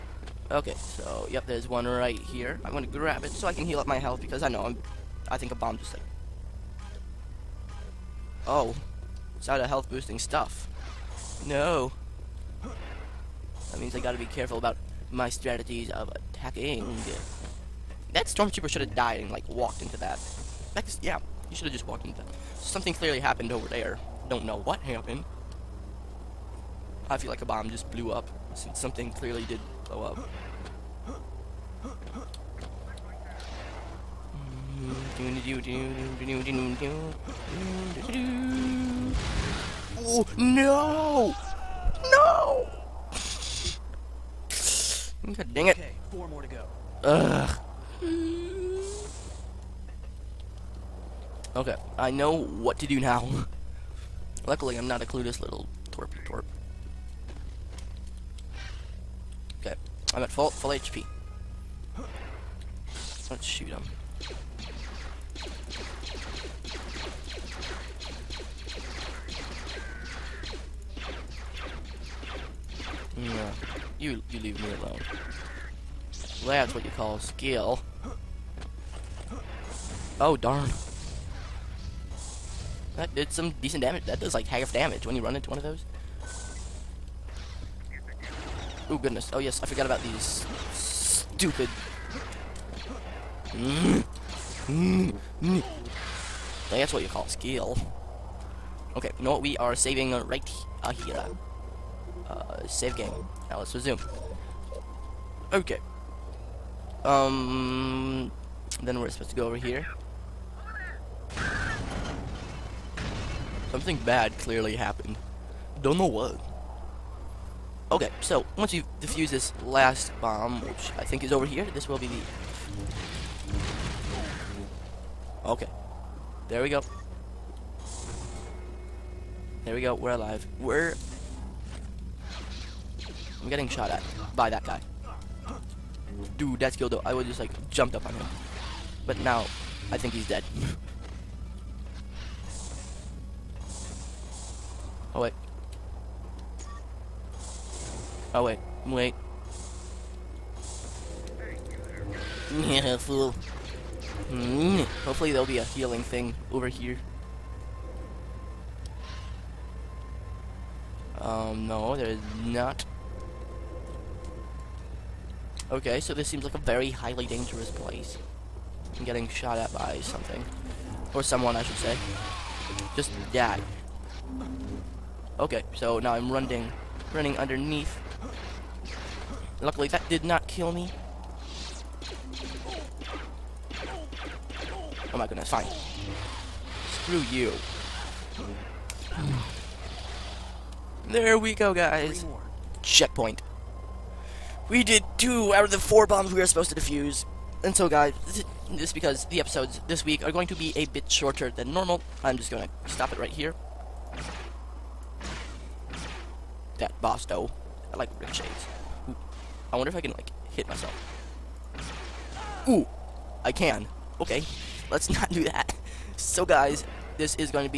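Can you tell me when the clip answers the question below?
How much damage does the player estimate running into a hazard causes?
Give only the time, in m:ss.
1:24.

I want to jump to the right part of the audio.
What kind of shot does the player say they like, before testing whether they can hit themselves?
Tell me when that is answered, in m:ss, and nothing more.
3:28.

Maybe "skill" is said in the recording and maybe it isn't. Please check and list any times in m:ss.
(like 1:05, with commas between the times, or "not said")
1:17, 1:37.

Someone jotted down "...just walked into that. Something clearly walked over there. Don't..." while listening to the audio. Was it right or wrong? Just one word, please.
wrong.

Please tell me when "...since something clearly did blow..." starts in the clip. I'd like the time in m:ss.
0:28.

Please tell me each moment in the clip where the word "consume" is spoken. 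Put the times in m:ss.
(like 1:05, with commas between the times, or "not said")
not said.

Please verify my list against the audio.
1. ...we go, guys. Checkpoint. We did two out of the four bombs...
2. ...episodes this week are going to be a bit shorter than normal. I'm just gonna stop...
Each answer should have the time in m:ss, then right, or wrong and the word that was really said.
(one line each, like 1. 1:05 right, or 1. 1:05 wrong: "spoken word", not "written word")
1. 3:11 right
2. 3:19 right.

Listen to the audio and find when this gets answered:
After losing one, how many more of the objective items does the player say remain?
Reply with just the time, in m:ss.
0:46.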